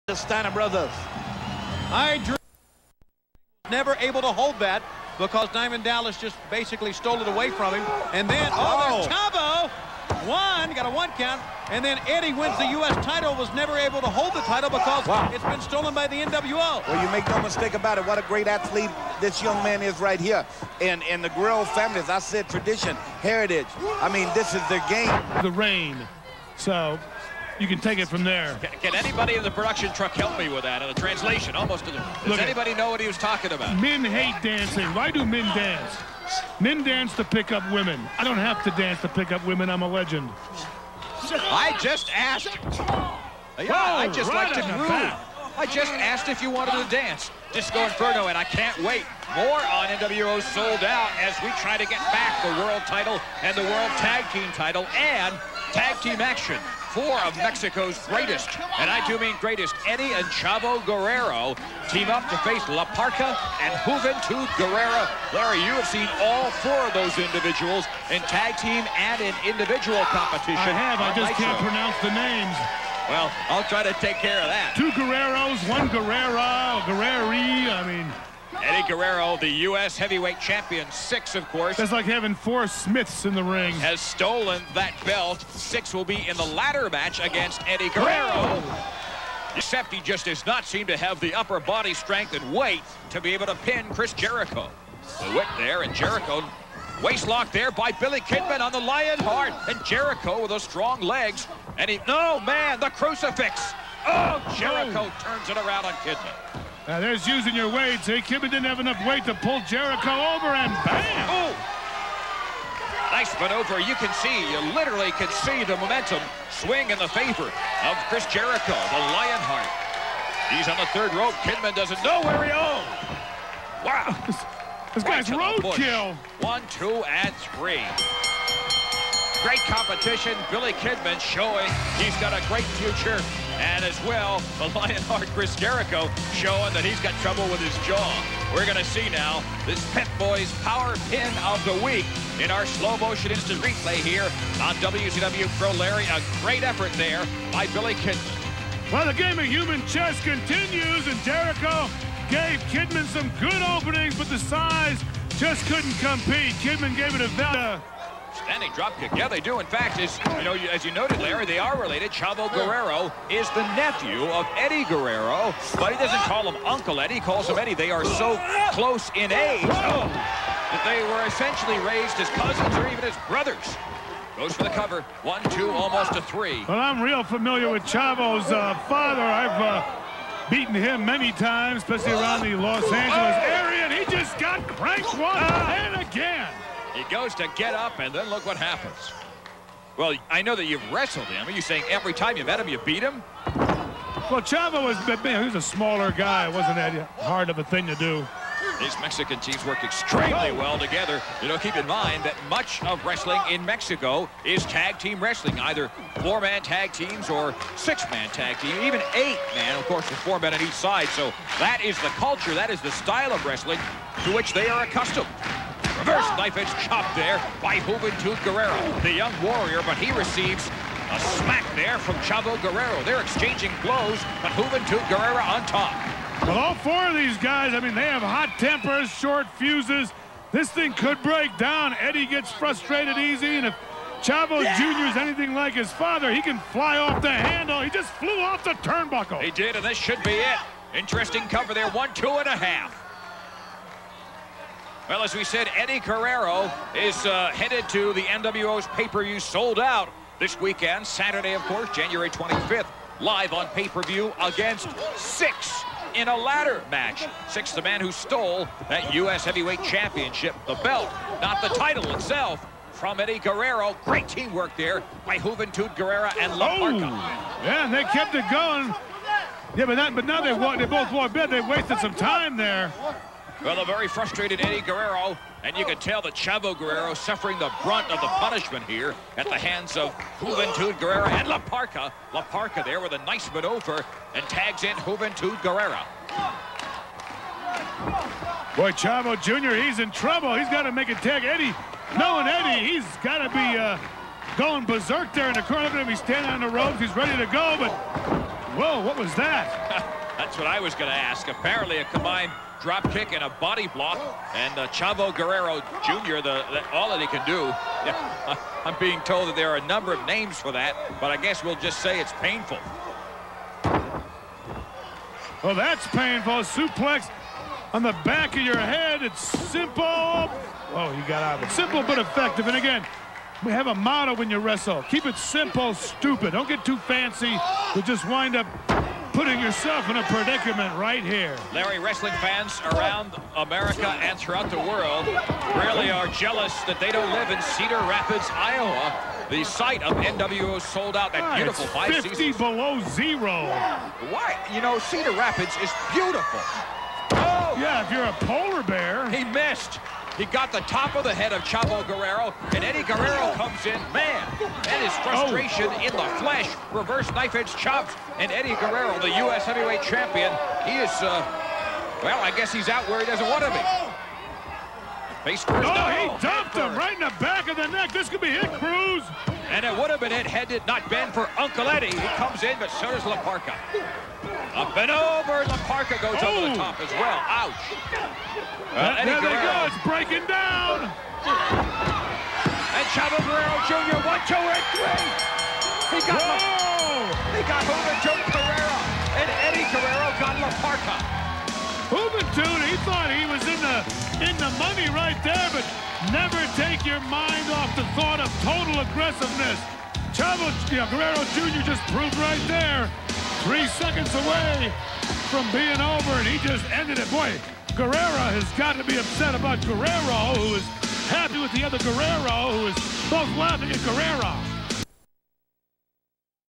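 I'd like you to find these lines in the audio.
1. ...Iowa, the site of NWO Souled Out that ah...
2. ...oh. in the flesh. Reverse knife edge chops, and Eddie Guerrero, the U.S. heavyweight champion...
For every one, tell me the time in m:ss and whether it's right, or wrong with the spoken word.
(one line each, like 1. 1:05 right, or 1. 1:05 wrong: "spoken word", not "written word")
1. 5:38 right
2. 5:55 right.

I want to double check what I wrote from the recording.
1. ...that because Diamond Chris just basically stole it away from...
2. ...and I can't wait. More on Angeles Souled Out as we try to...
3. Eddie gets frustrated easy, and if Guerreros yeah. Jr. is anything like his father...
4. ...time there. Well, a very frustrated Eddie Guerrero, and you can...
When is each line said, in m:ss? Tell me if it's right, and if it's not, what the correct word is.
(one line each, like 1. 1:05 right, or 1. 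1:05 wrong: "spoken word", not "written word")
1. 0:04 wrong: "Dallas", not "Chris"
2. 0:48 wrong: "NWO", not "Angeles"
3. 3:52 wrong: "Chavo", not "Guerreros"
4. 4:32 right.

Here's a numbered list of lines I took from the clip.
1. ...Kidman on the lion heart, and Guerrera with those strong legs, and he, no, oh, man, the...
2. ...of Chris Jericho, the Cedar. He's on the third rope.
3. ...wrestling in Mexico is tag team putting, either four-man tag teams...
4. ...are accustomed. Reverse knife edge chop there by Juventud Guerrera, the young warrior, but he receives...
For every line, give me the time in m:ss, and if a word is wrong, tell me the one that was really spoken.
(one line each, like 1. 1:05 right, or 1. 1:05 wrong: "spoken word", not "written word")
1. 1:38 wrong: "Jericho", not "Guerrera"
2. 1:57 wrong: "Lionheart", not "Cedar"
3. 3:23 wrong: "wrestling", not "putting"
4. 3:34 right.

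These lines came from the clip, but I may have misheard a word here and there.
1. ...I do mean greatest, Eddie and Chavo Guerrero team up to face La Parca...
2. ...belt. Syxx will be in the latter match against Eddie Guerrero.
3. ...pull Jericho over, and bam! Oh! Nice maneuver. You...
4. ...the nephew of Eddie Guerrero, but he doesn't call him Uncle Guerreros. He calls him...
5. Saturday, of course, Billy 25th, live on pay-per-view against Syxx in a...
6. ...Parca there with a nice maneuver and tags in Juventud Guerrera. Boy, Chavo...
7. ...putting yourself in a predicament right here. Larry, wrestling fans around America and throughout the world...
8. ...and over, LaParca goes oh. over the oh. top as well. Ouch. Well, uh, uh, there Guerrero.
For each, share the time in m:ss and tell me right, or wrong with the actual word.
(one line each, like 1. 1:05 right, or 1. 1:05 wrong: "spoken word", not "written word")
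1. 0:58 right
2. 1:25 right
3. 1:49 right
4. 2:43 wrong: "Eddie", not "Guerreros"
5. 4:11 wrong: "January", not "Billy"
6. 4:42 right
7. 5:29 right
8. 6:14 right.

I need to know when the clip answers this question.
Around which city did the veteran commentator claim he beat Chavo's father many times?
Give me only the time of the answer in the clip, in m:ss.
3:02.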